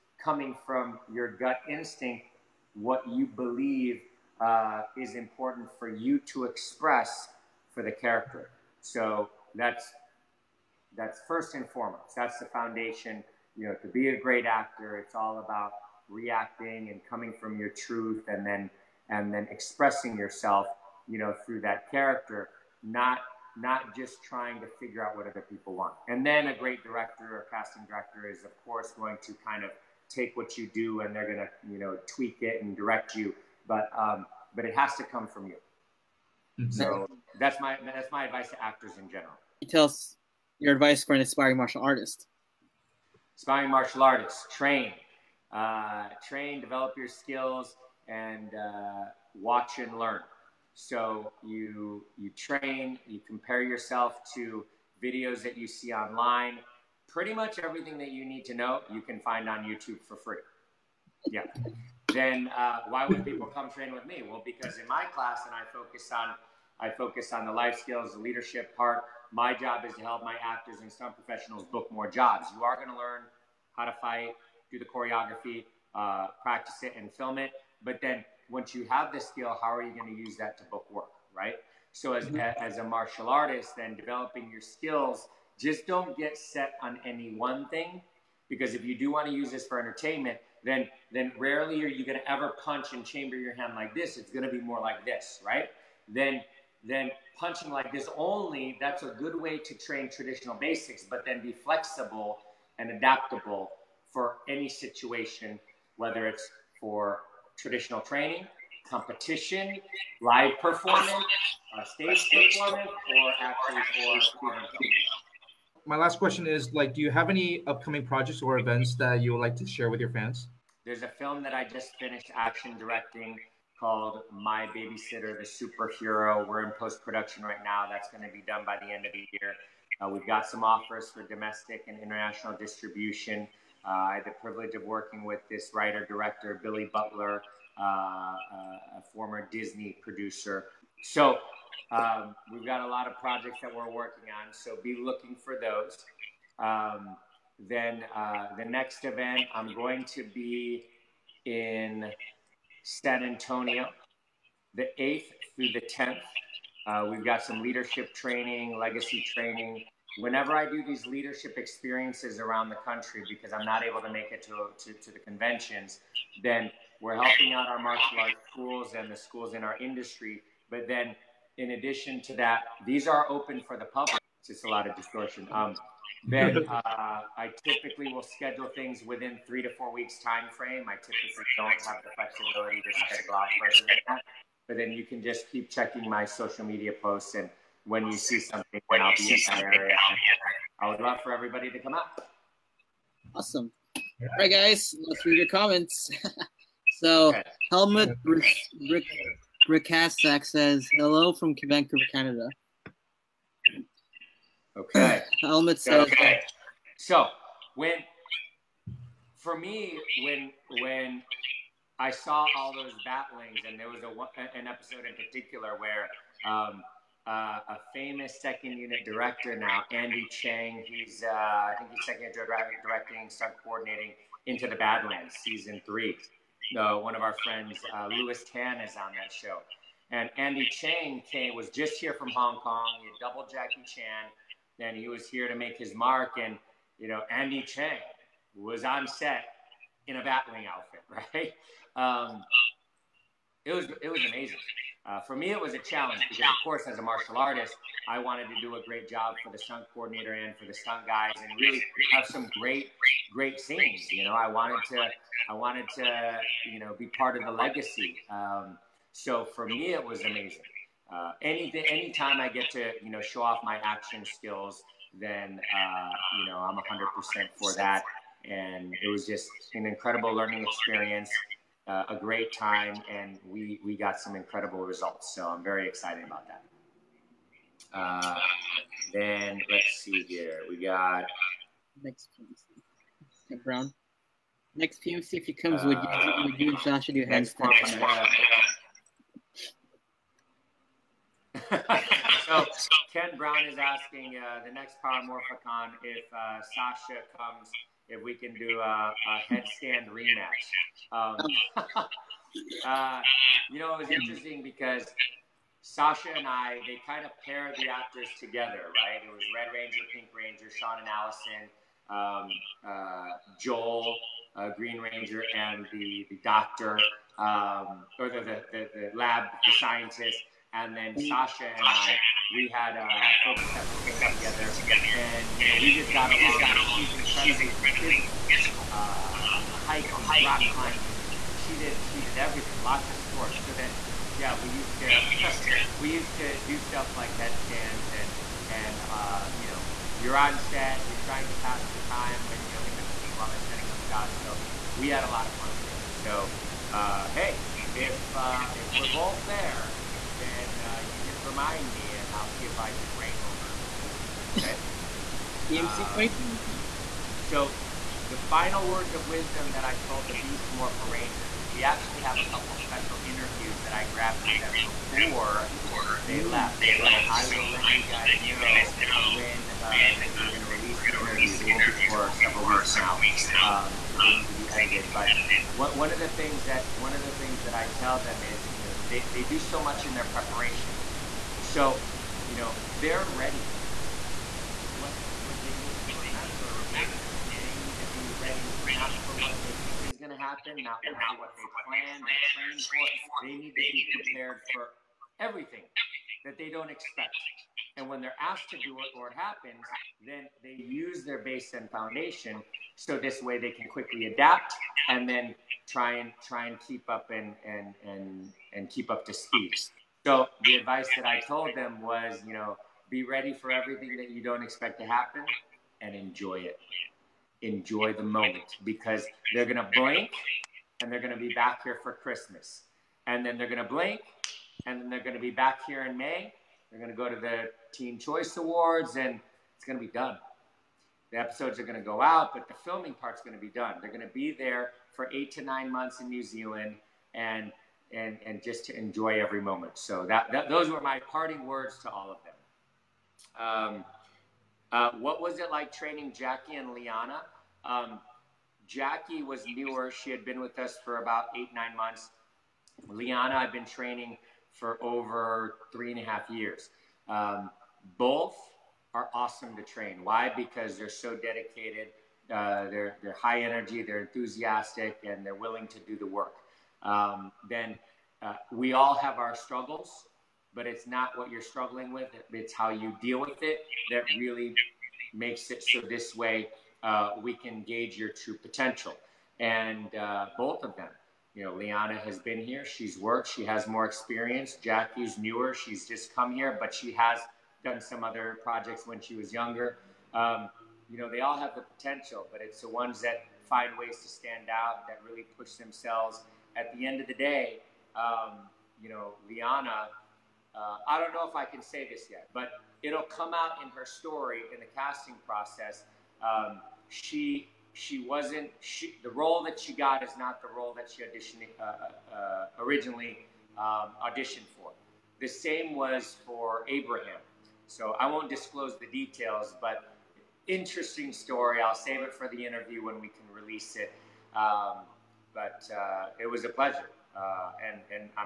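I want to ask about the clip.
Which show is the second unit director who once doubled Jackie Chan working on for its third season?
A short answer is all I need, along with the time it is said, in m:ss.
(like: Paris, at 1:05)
Into the Badlands, at 3:44.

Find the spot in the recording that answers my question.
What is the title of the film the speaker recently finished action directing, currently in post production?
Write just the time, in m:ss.
2:04.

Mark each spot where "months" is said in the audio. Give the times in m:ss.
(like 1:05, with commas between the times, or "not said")
7:15, 7:31.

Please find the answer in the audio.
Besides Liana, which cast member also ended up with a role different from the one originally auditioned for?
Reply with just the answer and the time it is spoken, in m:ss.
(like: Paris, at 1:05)
Abraham, at 8:36.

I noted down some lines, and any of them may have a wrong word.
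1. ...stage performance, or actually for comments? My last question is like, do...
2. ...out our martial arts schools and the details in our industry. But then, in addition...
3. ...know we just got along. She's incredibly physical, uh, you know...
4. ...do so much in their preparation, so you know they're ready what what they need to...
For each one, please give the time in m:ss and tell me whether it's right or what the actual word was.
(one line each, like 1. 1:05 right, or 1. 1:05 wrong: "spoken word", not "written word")
1. 1:52 wrong: "students", not "comments"
2. 2:47 wrong: "schools", not "details"
3. 5:25 right
4. 6:19 right.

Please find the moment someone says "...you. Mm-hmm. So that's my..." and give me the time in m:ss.
0:35.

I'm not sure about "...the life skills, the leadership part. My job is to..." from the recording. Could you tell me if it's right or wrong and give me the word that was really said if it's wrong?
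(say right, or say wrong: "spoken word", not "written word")
right.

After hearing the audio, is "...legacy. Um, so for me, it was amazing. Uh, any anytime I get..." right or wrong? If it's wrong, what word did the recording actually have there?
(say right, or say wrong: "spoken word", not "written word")
right.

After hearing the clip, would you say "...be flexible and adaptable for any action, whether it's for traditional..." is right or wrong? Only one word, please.
wrong.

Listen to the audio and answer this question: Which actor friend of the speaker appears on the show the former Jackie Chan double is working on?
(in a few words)
Lewis Tan.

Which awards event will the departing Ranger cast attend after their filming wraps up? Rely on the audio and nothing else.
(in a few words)
Teen Choice Awards.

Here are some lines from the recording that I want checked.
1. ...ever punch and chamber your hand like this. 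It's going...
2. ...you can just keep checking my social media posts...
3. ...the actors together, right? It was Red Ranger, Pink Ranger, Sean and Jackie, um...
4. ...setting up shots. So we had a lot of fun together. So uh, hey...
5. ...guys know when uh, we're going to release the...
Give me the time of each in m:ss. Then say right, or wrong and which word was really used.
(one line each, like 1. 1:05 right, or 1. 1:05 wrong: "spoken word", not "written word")
1. 1:32 right
2. 3:04 right
3. 5:07 wrong: "Allison", not "Jackie"
4. 5:43 right
5. 6:08 right.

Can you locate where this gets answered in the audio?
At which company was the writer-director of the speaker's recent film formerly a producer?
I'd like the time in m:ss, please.
2:19.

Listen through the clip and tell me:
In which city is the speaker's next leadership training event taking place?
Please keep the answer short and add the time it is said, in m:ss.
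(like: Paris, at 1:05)
San Antonio, at 2:32.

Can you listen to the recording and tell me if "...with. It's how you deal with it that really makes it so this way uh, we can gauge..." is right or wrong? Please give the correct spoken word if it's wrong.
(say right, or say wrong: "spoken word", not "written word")
right.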